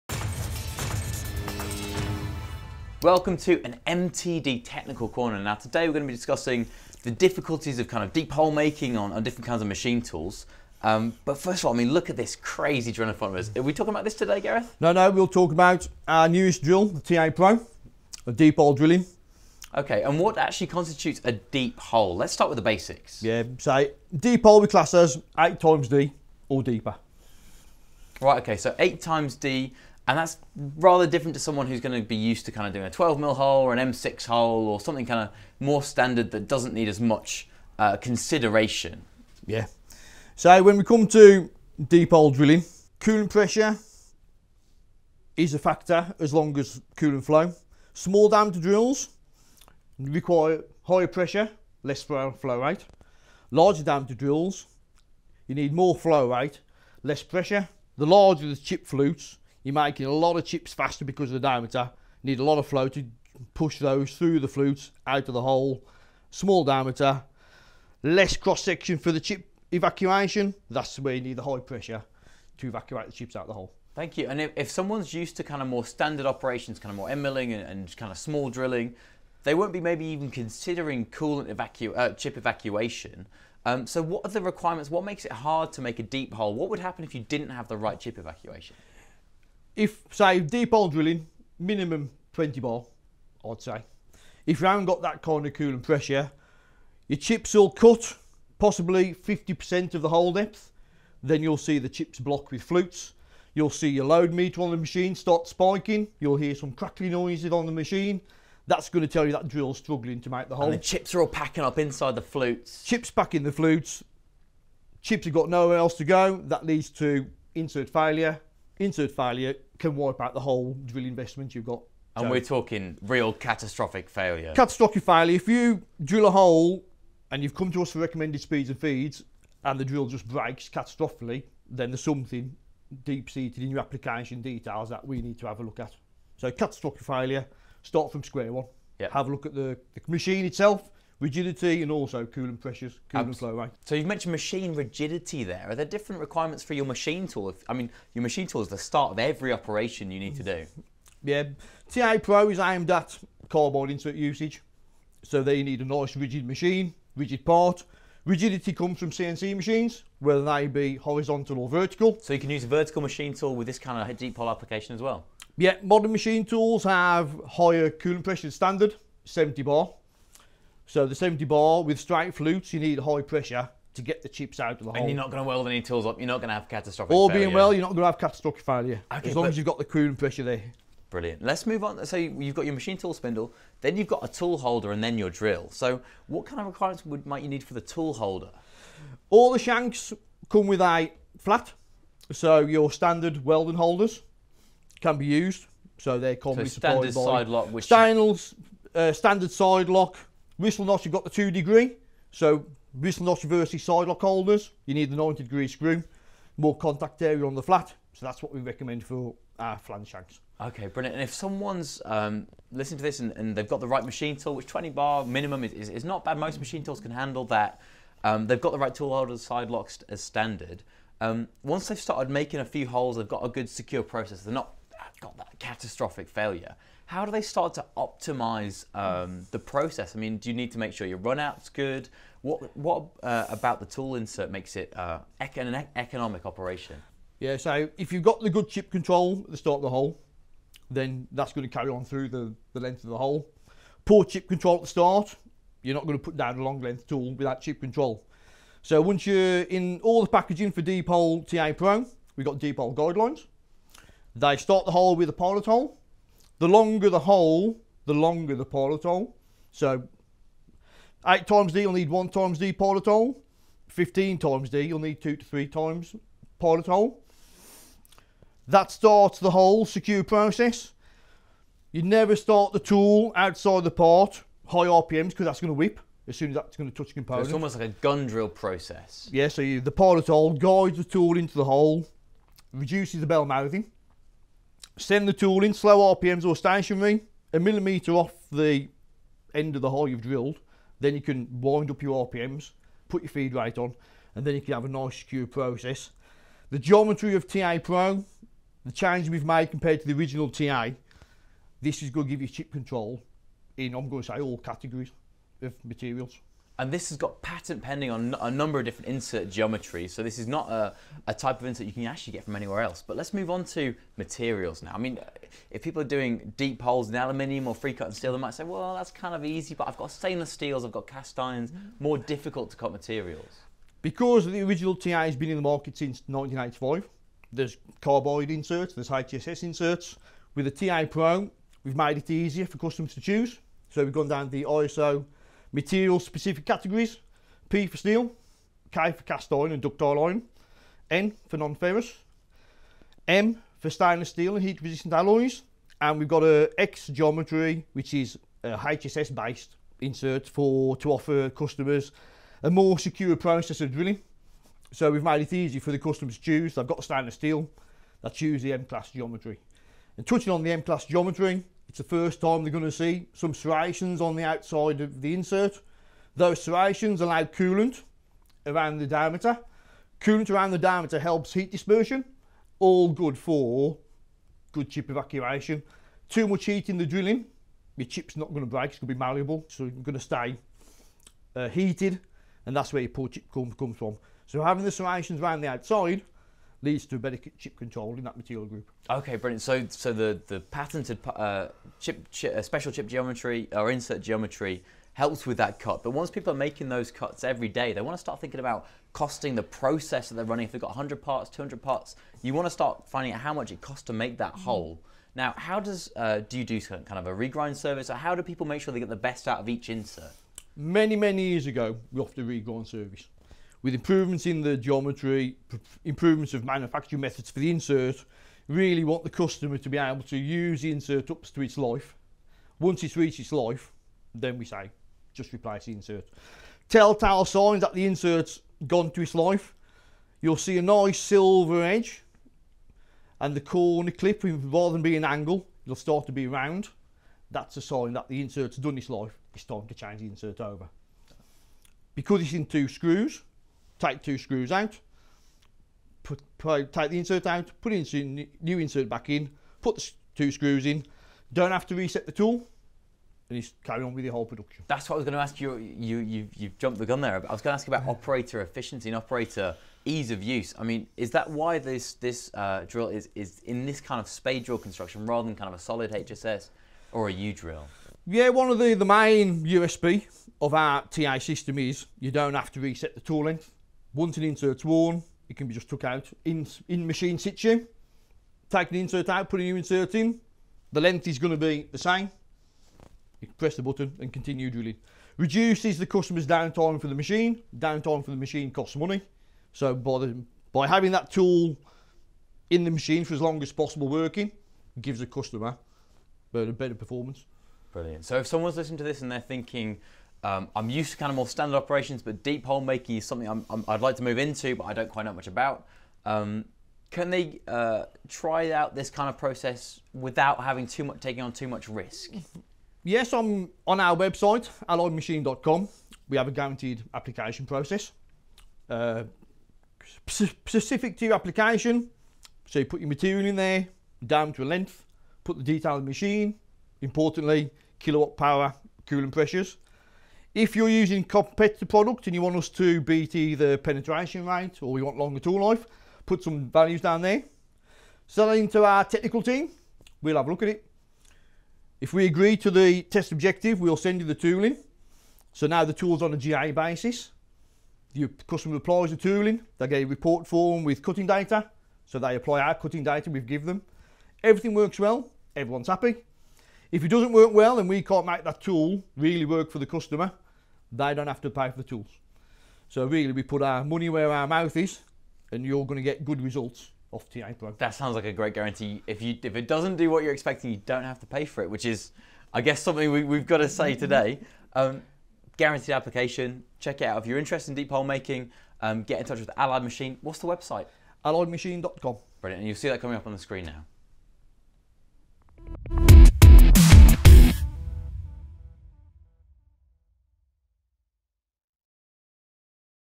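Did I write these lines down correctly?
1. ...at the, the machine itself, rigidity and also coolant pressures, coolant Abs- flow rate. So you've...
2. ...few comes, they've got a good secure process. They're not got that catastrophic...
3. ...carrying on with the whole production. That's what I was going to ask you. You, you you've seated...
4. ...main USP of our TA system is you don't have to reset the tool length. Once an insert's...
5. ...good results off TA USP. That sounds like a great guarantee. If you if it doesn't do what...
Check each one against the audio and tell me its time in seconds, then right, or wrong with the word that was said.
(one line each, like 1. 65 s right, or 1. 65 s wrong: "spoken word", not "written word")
1. 139 s right
2. 222 s wrong: "holes", not "comes"
3. 453 s wrong: "jumped", not "seated"
4. 469 s right
5. 566 s wrong: "Pro", not "USP".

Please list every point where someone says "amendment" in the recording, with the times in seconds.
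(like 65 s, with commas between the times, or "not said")
not said.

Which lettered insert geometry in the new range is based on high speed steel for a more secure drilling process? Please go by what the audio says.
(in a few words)
X.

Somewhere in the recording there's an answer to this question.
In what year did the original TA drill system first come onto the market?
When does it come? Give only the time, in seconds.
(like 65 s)
326 s.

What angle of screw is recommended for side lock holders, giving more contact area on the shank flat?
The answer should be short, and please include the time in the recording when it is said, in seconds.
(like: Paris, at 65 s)
90 degree, at 205 s.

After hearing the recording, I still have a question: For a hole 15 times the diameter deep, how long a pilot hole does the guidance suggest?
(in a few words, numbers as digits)
2 to 3 times.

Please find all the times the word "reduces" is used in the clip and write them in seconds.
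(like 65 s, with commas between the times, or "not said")
282 s, 485 s.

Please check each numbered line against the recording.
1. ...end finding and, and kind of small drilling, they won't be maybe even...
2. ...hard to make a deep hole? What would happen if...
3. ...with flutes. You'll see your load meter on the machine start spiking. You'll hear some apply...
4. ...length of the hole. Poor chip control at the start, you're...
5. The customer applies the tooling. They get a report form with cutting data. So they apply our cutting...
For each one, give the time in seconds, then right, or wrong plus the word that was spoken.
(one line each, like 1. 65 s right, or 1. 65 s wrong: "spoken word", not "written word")
1. 77 s wrong: "milling", not "finding"
2. 85 s right
3. 102 s wrong: "crackly", not "apply"
4. 242 s right
5. 548 s right.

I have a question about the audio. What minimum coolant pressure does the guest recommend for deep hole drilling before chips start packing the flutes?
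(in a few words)
20 bar.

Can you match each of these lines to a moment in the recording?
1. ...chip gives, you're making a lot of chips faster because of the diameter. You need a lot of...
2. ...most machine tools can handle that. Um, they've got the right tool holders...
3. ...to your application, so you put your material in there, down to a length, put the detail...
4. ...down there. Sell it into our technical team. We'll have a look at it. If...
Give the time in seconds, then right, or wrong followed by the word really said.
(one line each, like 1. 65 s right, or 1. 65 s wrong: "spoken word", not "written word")
1. 58 s wrong: "flutes", not "gives"
2. 216 s right
3. 521 s right
4. 536 s right.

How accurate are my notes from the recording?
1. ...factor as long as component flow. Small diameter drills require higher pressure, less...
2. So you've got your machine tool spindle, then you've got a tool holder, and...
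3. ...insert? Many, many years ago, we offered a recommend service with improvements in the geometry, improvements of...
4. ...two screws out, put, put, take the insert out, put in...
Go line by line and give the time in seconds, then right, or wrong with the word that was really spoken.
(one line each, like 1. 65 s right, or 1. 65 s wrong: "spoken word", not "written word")
1. 45 s wrong: "coolant", not "component"
2. 182 s right
3. 409 s wrong: "regrind", not "recommend"
4. 444 s right.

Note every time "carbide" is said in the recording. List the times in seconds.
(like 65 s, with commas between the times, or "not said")
153 s, 328 s.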